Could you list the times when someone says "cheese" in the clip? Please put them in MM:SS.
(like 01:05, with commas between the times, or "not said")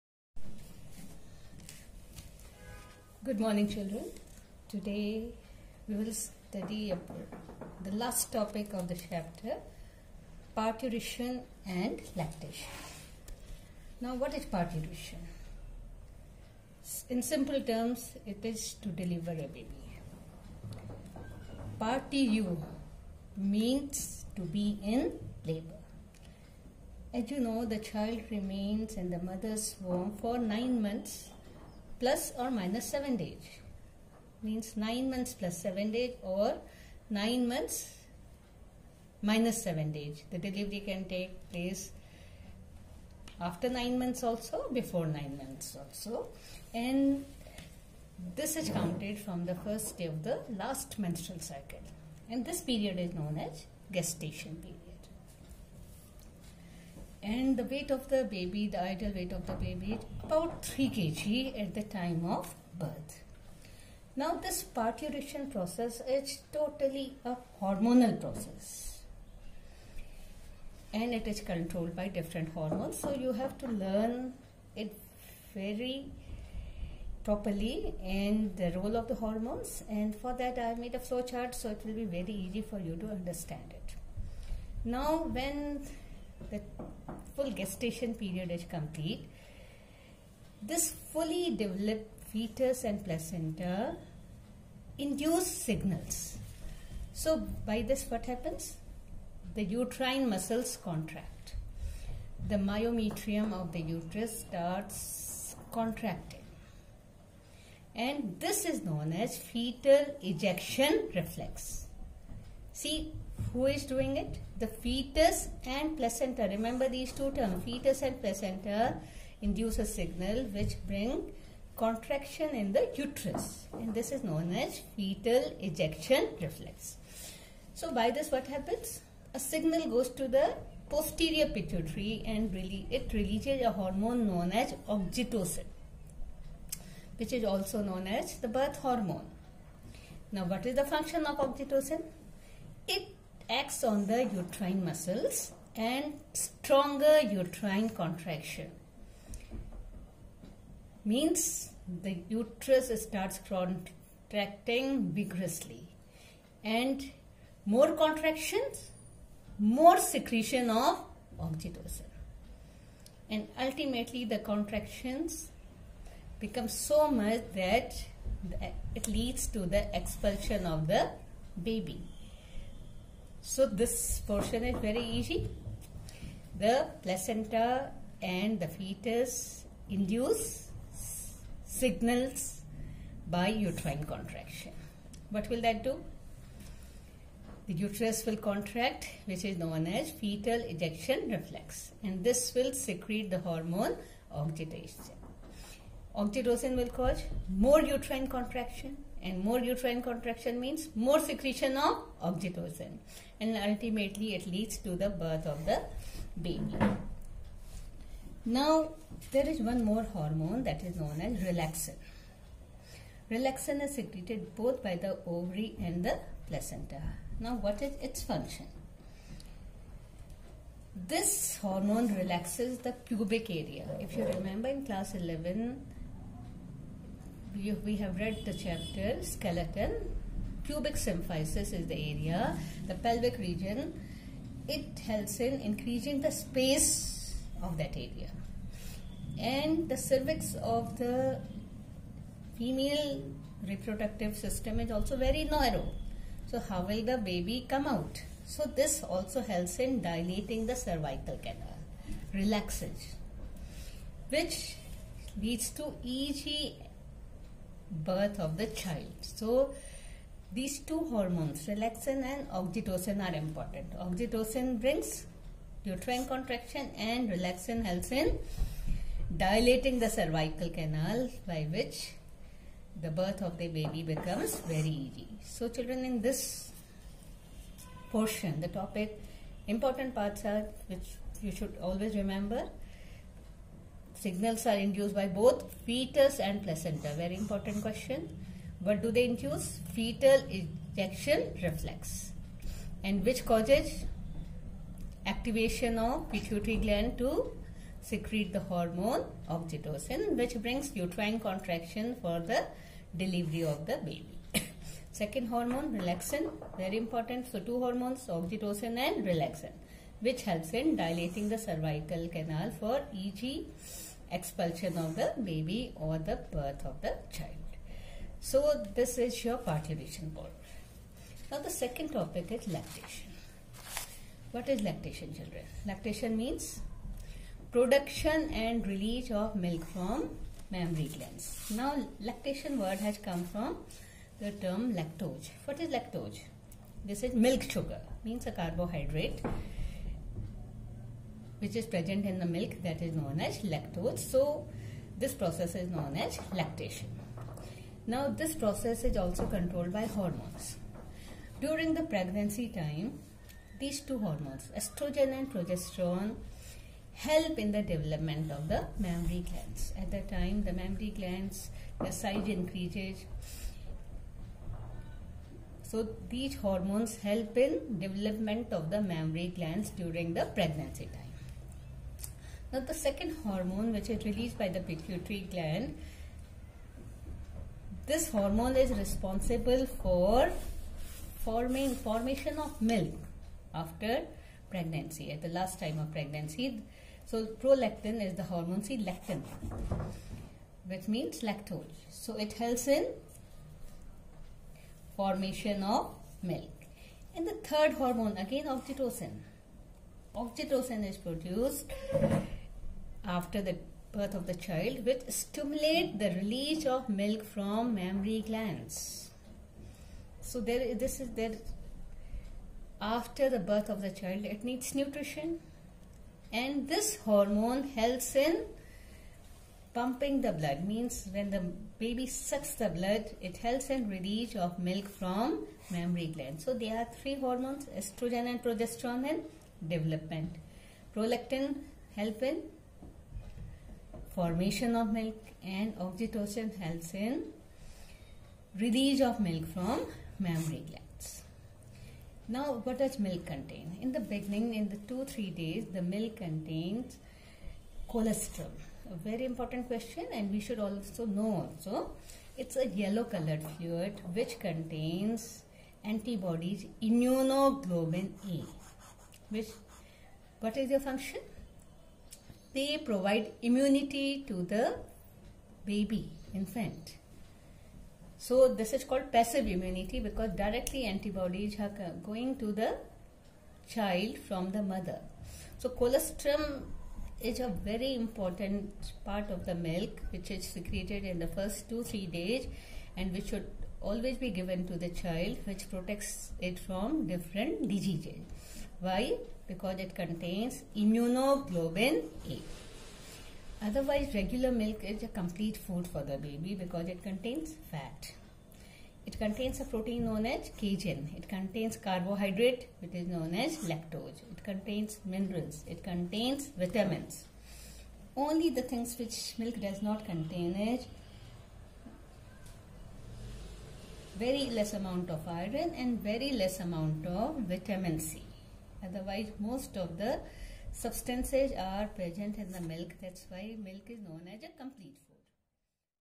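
not said.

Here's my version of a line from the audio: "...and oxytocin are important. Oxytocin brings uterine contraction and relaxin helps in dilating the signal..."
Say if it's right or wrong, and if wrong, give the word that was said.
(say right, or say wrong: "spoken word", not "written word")
wrong: "cervical", not "signal".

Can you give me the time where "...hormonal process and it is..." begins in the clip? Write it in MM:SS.
01:07.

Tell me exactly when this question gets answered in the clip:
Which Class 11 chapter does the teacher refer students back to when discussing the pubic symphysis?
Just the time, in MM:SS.
03:49.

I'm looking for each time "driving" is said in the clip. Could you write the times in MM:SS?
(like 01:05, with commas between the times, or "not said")
not said.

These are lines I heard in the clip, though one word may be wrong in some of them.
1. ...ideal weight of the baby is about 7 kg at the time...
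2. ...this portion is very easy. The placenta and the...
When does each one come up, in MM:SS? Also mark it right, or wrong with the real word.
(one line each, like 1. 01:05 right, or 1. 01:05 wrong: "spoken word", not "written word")
1. 00:58 wrong: "3", not "7"
2. 02:53 right.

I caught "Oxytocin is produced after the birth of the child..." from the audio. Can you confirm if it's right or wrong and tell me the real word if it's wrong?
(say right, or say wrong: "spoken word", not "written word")
right.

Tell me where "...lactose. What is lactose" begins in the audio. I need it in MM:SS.
05:34.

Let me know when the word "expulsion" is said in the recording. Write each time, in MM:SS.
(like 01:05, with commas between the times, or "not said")
02:50, 05:14.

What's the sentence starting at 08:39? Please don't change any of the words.
Otherwise, most of the substances are present in the milk.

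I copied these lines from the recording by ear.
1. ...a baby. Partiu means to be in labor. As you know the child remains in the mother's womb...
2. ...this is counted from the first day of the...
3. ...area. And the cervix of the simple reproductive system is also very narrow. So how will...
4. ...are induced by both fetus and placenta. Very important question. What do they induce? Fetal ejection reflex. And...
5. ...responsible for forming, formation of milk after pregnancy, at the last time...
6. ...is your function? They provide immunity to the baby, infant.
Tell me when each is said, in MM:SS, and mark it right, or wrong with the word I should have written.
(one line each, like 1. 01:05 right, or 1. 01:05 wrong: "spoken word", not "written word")
1. 00:19 right
2. 00:48 right
3. 03:57 wrong: "female", not "simple"
4. 04:44 right
5. 06:18 right
6. 07:40 right.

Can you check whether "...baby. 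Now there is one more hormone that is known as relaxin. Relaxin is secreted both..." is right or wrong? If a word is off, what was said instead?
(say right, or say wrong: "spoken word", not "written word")
right.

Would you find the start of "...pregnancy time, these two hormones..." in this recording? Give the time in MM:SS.
05:52.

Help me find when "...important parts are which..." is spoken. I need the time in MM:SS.
04:39.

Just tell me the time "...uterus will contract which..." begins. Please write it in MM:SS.
03:07.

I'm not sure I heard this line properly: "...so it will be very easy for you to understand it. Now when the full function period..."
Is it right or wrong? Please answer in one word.
wrong.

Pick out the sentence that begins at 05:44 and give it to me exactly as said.
So this process is known as lactation.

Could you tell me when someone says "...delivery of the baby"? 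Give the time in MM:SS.
05:03.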